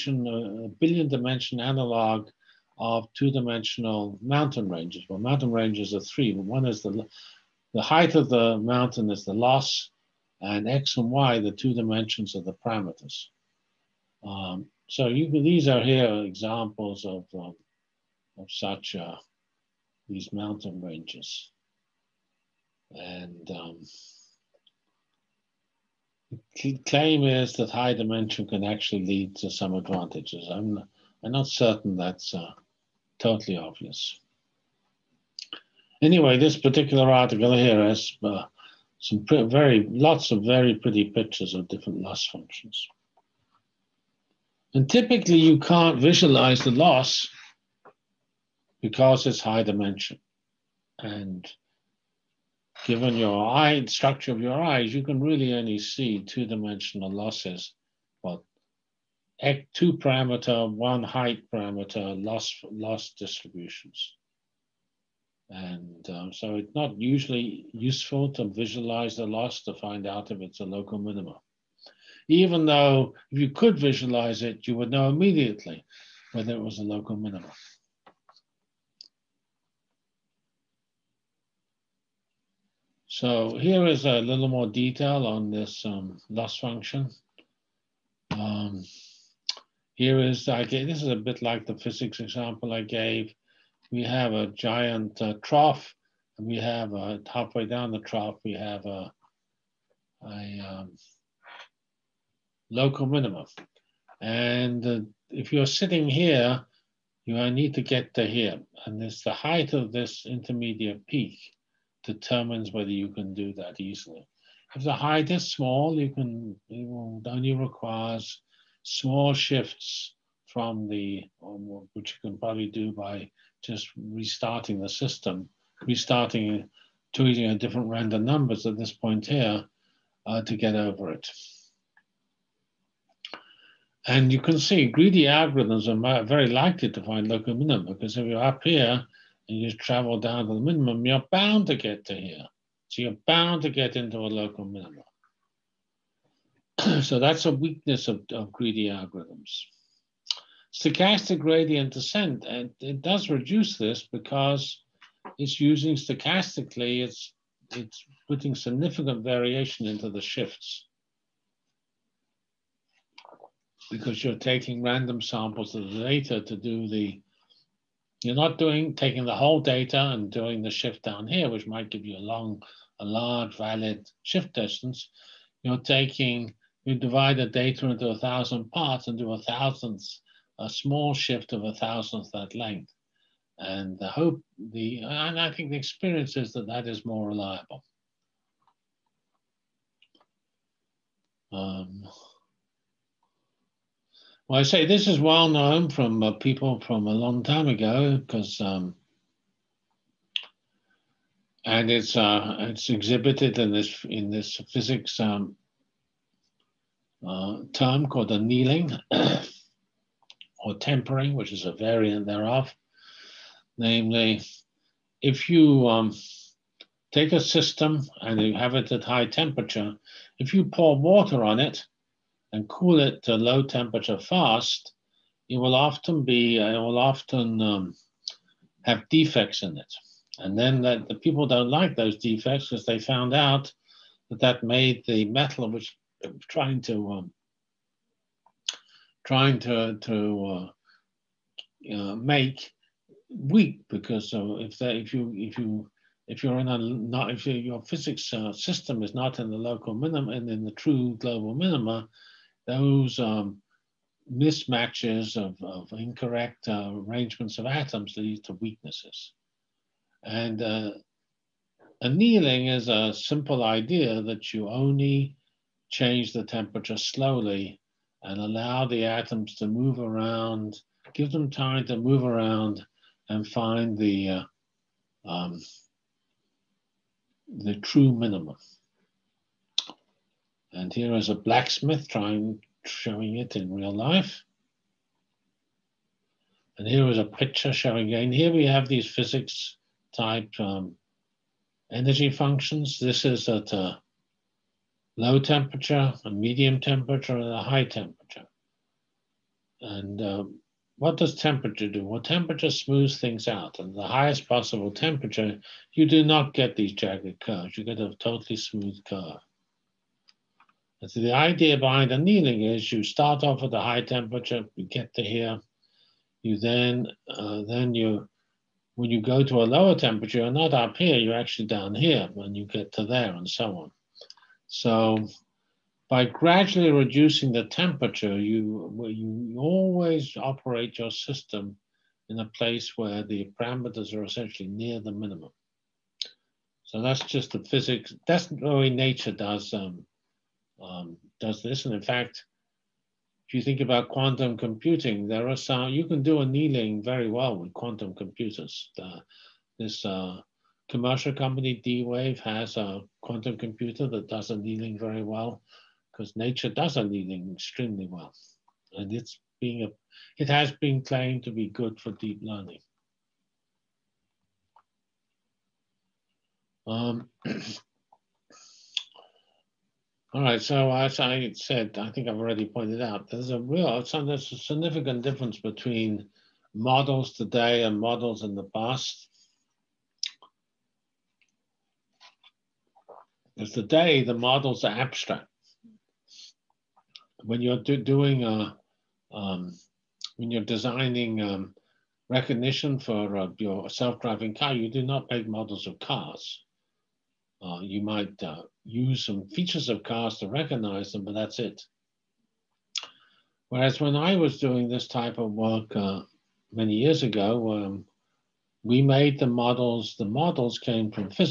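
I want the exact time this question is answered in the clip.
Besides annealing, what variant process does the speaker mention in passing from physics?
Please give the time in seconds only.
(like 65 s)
210 s.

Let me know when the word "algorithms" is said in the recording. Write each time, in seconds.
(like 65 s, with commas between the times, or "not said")
135 s, 148 s.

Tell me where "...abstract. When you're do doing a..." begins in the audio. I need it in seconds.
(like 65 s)
384 s.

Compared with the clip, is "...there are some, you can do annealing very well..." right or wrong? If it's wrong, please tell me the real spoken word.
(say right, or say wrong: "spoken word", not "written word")
right.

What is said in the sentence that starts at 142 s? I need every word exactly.
So you're bound to get into a local minimum.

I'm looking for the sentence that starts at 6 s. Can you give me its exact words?
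One is the the height of the mountain is the loss and x and y, the two dimensions of the parameters.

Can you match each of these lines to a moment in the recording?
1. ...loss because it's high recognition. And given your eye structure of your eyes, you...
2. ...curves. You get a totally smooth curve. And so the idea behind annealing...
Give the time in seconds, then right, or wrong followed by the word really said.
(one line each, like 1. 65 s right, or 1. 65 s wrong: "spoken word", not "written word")
1. 46 s wrong: "dimension", not "recognition"
2. 307 s right.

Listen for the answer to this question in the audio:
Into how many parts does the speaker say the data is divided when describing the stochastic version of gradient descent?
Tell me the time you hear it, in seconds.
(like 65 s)
178 s.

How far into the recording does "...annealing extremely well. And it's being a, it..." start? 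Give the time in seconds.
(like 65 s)
356 s.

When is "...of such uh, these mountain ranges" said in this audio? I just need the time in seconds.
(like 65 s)
18 s.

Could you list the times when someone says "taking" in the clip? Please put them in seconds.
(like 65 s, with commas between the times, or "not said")
164 s, 168 s, 175 s.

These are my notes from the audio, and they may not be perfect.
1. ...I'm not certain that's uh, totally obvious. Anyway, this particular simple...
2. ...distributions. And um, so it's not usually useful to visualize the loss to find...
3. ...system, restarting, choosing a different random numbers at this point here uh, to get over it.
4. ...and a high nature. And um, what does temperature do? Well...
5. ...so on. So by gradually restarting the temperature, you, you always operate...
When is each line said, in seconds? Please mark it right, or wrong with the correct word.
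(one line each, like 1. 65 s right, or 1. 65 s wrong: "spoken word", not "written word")
1. 31 s wrong: "article", not "simple"
2. 63 s right
3. 124 s right
4. 297 s wrong: "temperature", not "nature"
5. 323 s wrong: "reducing", not "restarting".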